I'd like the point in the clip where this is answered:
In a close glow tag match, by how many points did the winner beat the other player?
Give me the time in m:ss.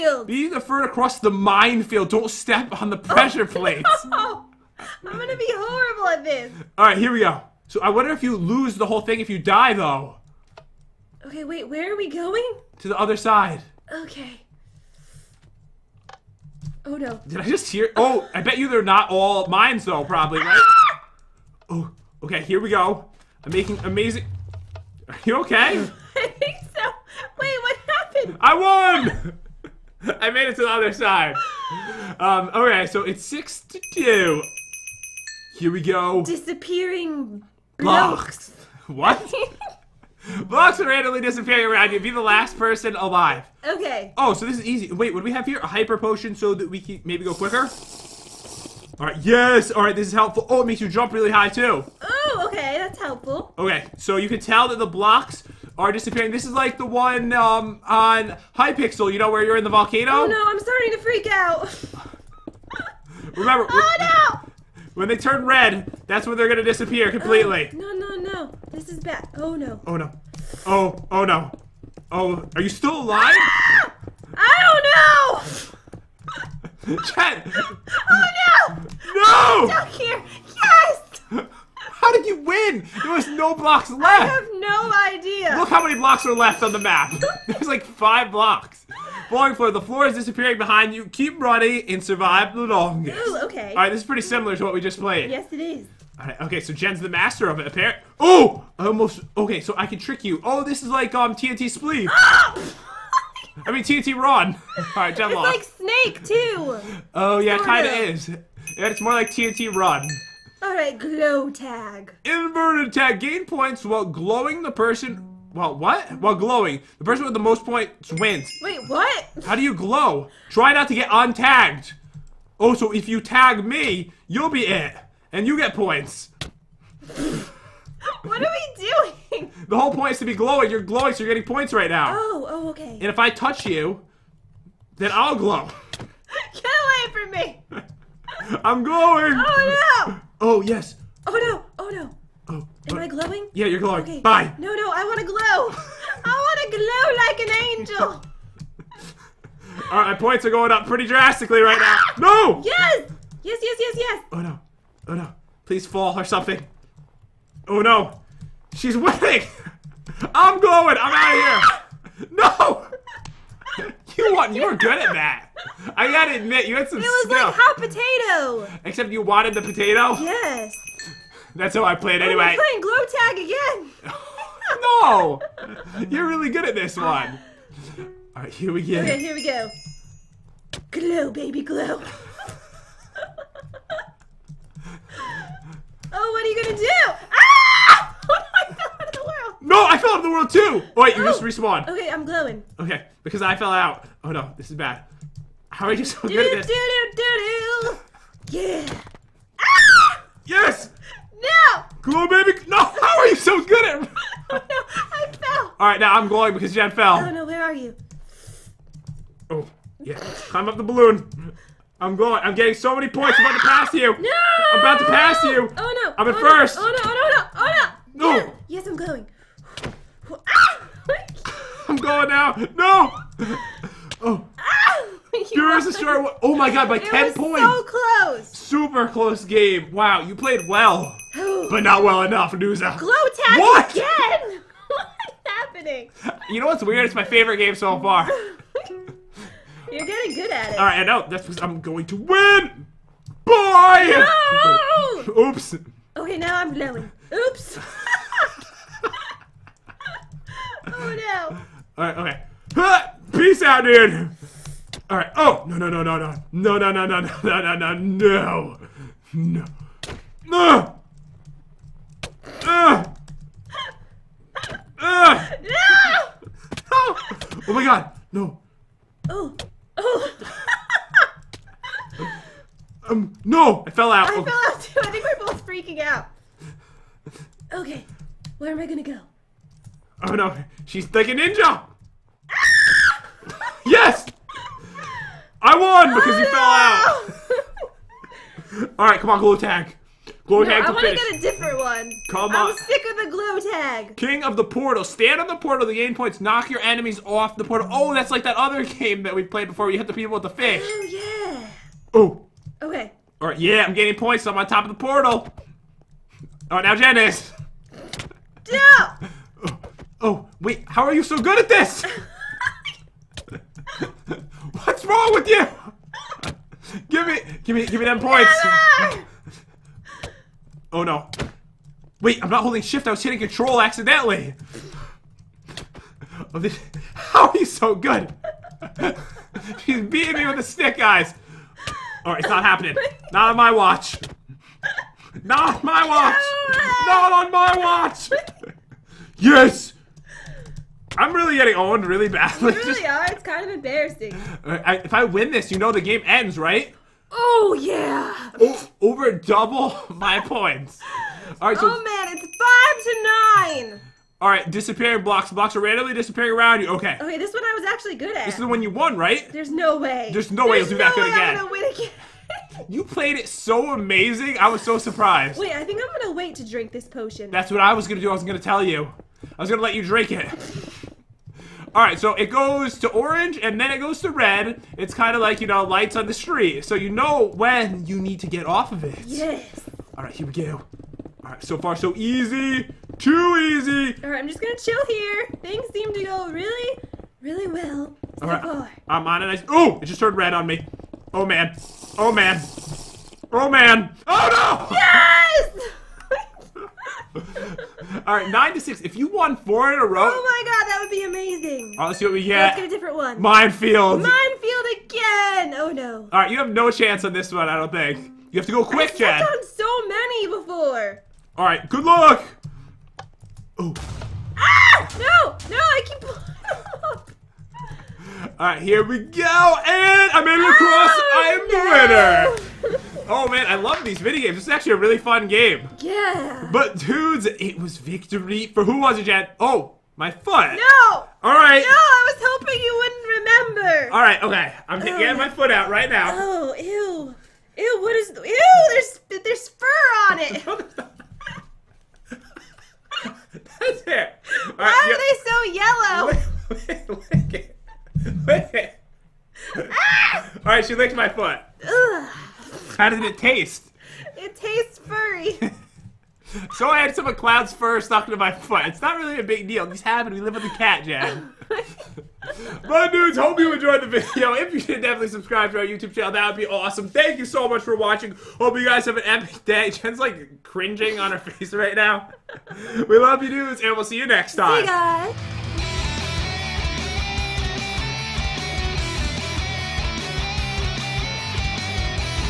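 3:47.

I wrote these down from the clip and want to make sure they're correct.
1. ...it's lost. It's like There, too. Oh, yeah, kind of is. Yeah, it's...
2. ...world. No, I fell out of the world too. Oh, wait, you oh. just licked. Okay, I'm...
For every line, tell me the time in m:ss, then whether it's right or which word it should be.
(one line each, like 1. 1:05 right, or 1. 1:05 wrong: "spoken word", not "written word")
1. 1:45 wrong: "Snake", not "There"
2. 3:09 wrong: "respawned", not "licked".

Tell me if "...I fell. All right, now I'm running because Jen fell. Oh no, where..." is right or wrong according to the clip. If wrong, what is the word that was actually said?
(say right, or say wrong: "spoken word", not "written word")
wrong: "glowing", not "running".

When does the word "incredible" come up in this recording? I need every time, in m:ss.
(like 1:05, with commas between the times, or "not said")
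not said.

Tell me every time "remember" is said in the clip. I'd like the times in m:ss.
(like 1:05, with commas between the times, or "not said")
1:03, 7:13.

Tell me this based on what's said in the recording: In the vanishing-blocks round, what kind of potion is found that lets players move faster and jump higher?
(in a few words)
Hyper potion.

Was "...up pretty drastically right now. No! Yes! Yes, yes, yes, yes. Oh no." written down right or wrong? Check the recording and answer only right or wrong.
right.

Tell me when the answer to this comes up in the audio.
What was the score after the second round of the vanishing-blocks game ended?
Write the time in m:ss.
6:38.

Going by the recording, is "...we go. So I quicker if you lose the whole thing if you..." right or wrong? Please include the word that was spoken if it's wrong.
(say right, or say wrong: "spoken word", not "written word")
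wrong: "wonder", not "quicker".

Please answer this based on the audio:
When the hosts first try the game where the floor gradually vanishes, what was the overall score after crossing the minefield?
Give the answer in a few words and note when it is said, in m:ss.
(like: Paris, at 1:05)
6 to 2, at 0:33.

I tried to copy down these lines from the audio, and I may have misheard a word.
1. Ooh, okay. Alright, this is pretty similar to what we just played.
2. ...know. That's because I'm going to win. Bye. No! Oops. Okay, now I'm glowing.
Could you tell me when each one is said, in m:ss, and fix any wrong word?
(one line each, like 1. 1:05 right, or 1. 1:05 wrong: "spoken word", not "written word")
1. 1:33 right
2. 4:01 right.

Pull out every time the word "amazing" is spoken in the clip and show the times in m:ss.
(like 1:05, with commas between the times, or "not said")
0:23, 6:03, 6:41.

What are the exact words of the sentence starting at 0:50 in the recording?
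Oh, it makes you jump really high, too.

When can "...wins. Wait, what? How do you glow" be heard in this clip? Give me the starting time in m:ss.
1:58.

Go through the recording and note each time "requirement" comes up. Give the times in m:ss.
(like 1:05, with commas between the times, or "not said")
not said.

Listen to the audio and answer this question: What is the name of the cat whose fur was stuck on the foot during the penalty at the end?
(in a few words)
Cloud.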